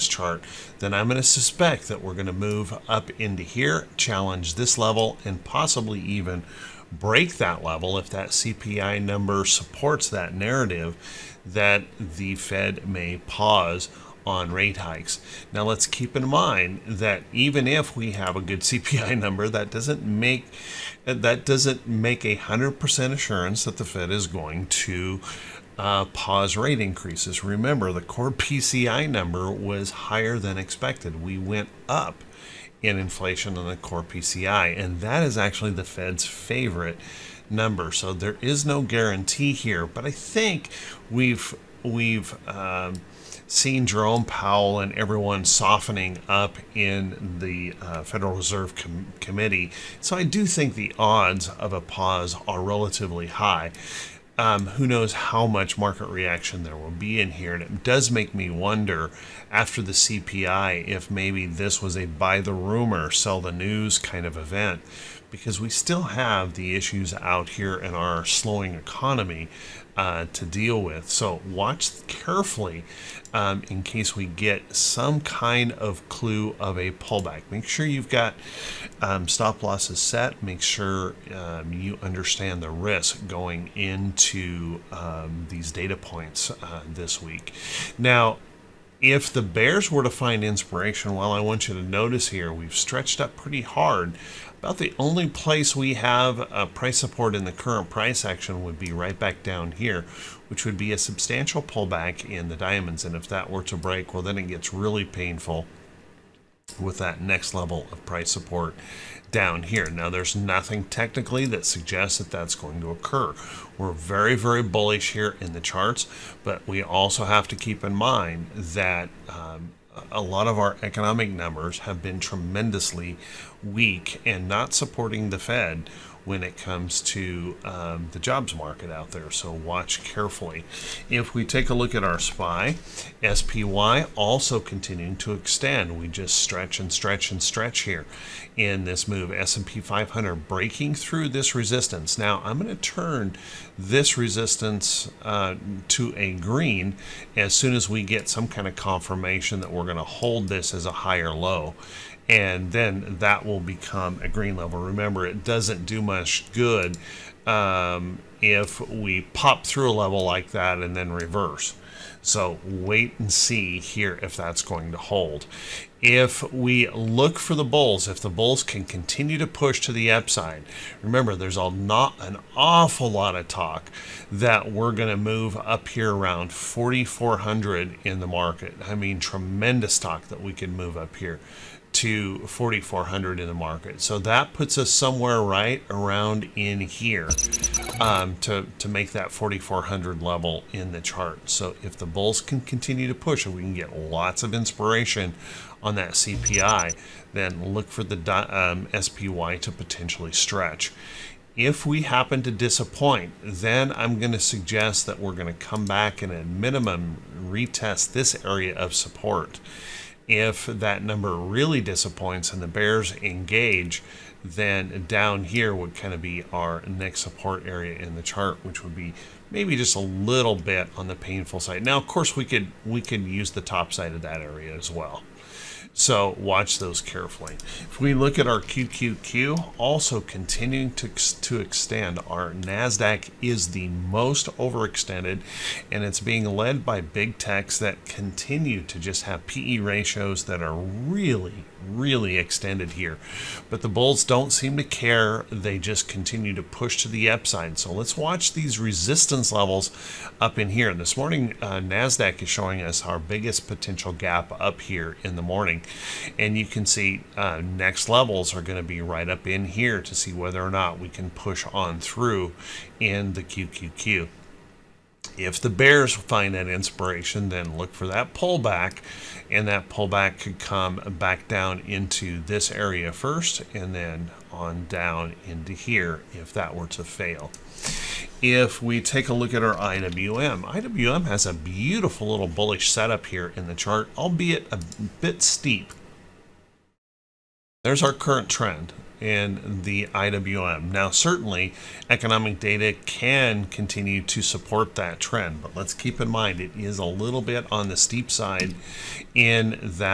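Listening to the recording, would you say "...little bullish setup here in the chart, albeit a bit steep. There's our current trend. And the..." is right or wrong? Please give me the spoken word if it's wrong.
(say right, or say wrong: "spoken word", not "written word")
right.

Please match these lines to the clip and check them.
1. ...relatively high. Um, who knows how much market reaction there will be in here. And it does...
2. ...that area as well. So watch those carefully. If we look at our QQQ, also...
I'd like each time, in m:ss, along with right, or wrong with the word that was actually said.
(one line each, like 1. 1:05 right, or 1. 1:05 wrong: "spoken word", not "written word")
1. 0:52 right
2. 3:44 right.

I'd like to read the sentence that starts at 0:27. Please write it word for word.
Remember, the core PCI number was higher than expected.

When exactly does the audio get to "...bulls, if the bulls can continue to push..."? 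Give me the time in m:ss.
2:47.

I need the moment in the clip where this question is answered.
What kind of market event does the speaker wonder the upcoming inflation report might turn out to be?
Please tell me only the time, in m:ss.
1:02.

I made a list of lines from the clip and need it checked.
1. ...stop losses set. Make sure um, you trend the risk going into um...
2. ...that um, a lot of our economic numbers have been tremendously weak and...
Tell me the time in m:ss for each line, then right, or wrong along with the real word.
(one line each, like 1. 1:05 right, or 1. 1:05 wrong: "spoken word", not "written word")
1. 1:19 wrong: "understand", not "trend"
2. 1:58 right.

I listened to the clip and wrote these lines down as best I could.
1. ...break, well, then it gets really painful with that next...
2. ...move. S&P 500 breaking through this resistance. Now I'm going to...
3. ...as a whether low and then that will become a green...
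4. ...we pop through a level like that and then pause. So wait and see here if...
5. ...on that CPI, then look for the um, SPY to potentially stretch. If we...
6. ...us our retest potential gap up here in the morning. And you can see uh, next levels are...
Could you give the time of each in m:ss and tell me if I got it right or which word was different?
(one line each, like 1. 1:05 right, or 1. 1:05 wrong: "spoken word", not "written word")
1. 1:43 right
2. 2:19 right
3. 2:30 wrong: "higher", not "whether"
4. 2:38 wrong: "reverse", not "pause"
5. 3:15 right
6. 4:12 wrong: "biggest", not "retest".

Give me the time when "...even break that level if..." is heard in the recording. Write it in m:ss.
0:05.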